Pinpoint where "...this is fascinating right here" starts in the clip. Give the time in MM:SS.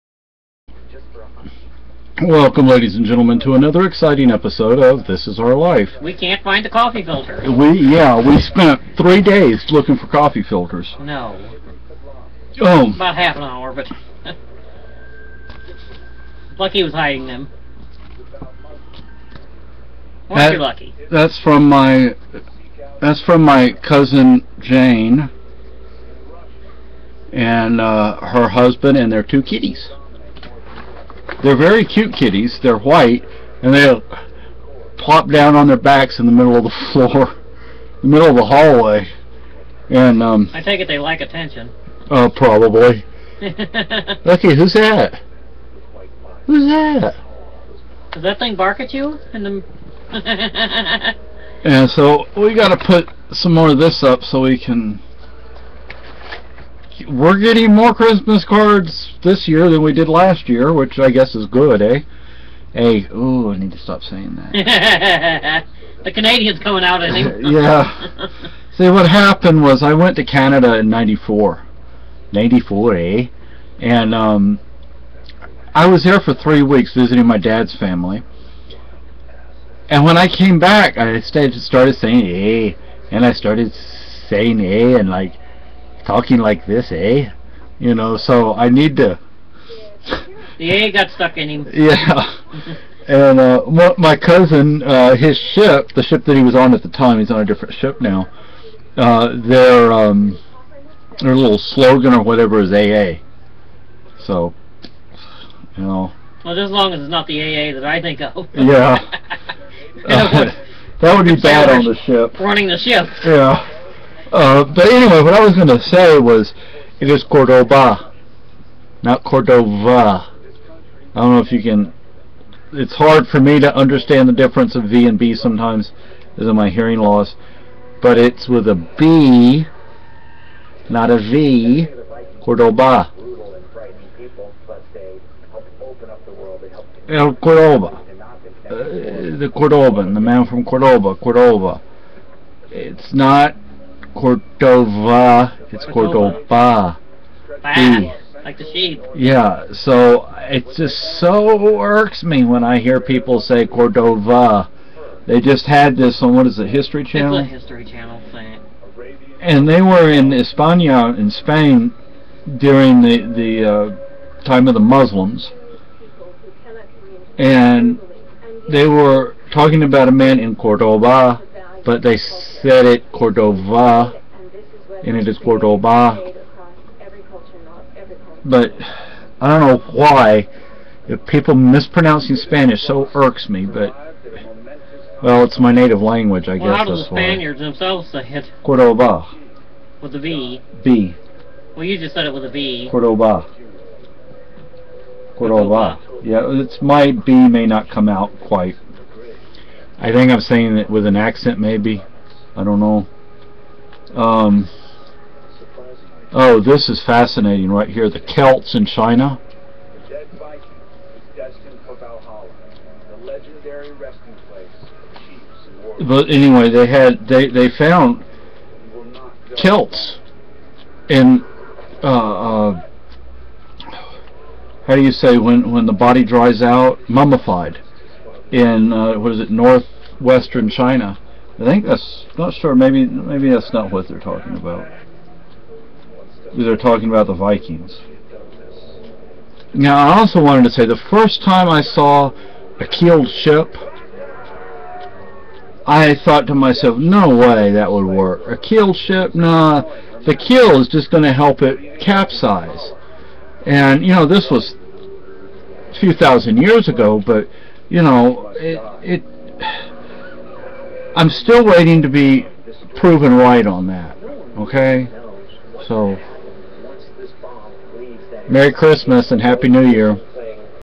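03:26.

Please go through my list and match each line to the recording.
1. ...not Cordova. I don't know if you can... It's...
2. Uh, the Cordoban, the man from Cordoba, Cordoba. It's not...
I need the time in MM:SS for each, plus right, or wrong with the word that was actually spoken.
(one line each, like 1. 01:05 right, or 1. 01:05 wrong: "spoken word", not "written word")
1. 01:59 right
2. 02:17 right.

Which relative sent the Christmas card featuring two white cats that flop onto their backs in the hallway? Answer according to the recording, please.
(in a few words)
Cousin Jane.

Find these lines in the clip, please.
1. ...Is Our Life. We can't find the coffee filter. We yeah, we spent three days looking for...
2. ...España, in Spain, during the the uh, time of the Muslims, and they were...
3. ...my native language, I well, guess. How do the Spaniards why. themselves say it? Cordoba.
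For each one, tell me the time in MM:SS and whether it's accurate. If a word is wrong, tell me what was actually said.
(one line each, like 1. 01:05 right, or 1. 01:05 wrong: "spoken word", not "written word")
1. 00:05 right
2. 02:40 right
3. 03:05 right.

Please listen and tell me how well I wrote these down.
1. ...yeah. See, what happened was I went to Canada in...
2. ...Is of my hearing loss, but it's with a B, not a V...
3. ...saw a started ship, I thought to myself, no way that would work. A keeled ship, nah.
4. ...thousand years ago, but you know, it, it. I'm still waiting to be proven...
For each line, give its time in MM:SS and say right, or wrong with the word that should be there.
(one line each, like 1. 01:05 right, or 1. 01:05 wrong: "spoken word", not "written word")
1. 01:07 right
2. 02:06 right
3. 04:01 wrong: "keeled", not "started"
4. 04:16 right.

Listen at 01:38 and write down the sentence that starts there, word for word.
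Uh, their um, their little slogan or whatever is AA.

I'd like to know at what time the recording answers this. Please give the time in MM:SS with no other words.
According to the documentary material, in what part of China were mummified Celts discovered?
03:49.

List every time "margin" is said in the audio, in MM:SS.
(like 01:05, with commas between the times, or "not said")
not said.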